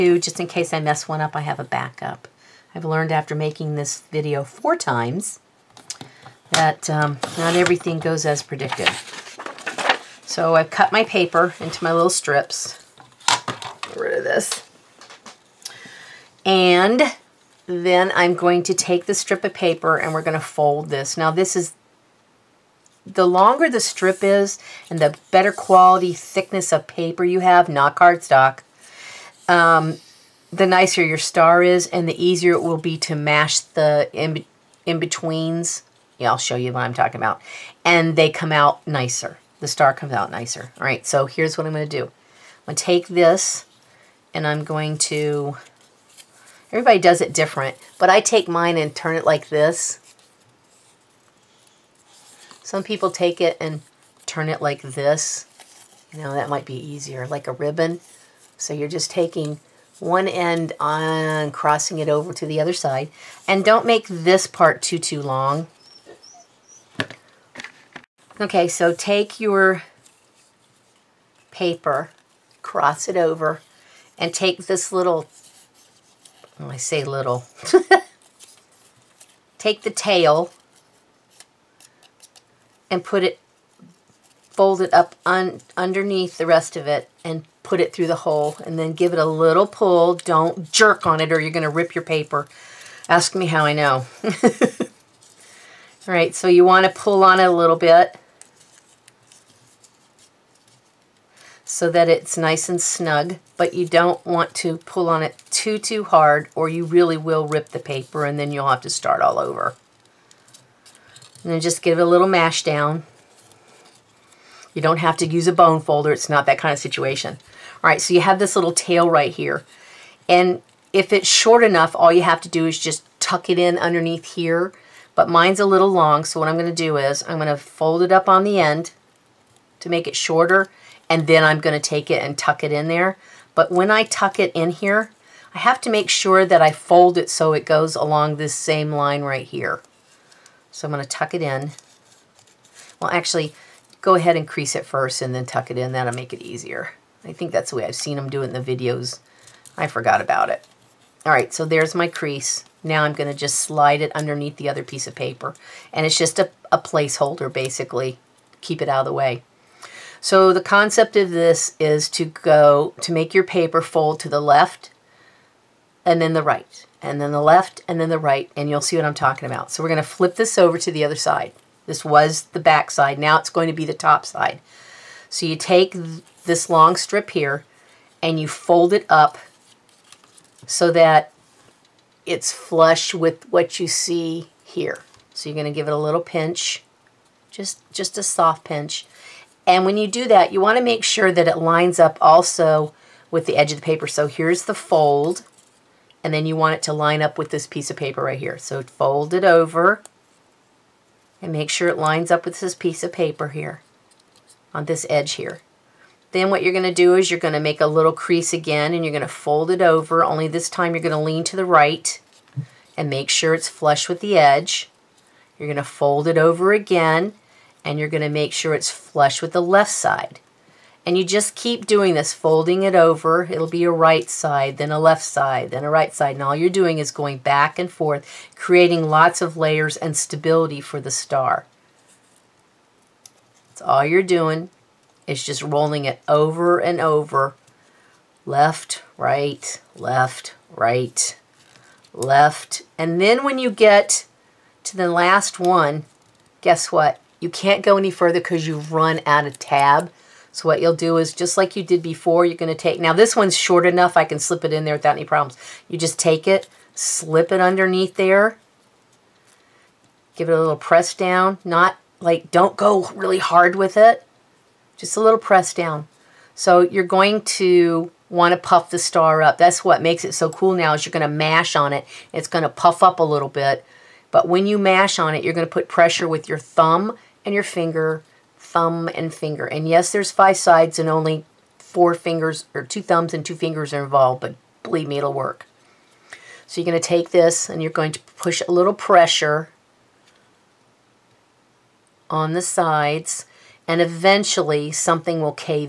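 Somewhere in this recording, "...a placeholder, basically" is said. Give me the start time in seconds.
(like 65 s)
156 s.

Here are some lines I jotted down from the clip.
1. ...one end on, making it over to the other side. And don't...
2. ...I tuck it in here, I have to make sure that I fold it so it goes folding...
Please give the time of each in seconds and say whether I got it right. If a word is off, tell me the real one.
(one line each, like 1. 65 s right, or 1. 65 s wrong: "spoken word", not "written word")
1. 59 s wrong: "crossing", not "making"
2. 133 s wrong: "along", not "folding".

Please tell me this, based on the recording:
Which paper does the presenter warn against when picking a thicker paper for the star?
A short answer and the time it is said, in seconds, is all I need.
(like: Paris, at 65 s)
cardstock, at 27 s.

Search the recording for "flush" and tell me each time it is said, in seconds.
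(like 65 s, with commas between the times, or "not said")
182 s, 213 s, 218 s.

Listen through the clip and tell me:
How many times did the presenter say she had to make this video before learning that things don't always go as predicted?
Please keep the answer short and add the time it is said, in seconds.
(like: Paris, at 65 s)
4, at 4 s.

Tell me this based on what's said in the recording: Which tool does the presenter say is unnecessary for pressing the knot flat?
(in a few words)
bone folder.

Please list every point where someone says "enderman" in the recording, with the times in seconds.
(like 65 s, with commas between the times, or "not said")
not said.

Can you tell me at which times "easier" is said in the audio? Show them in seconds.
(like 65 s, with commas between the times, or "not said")
32 s, 56 s, 146 s.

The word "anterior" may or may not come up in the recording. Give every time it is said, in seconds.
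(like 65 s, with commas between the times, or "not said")
not said.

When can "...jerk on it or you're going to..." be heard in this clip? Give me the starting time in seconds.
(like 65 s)
90 s.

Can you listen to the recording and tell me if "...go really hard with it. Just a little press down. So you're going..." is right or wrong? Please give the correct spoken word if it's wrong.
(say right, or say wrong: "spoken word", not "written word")
right.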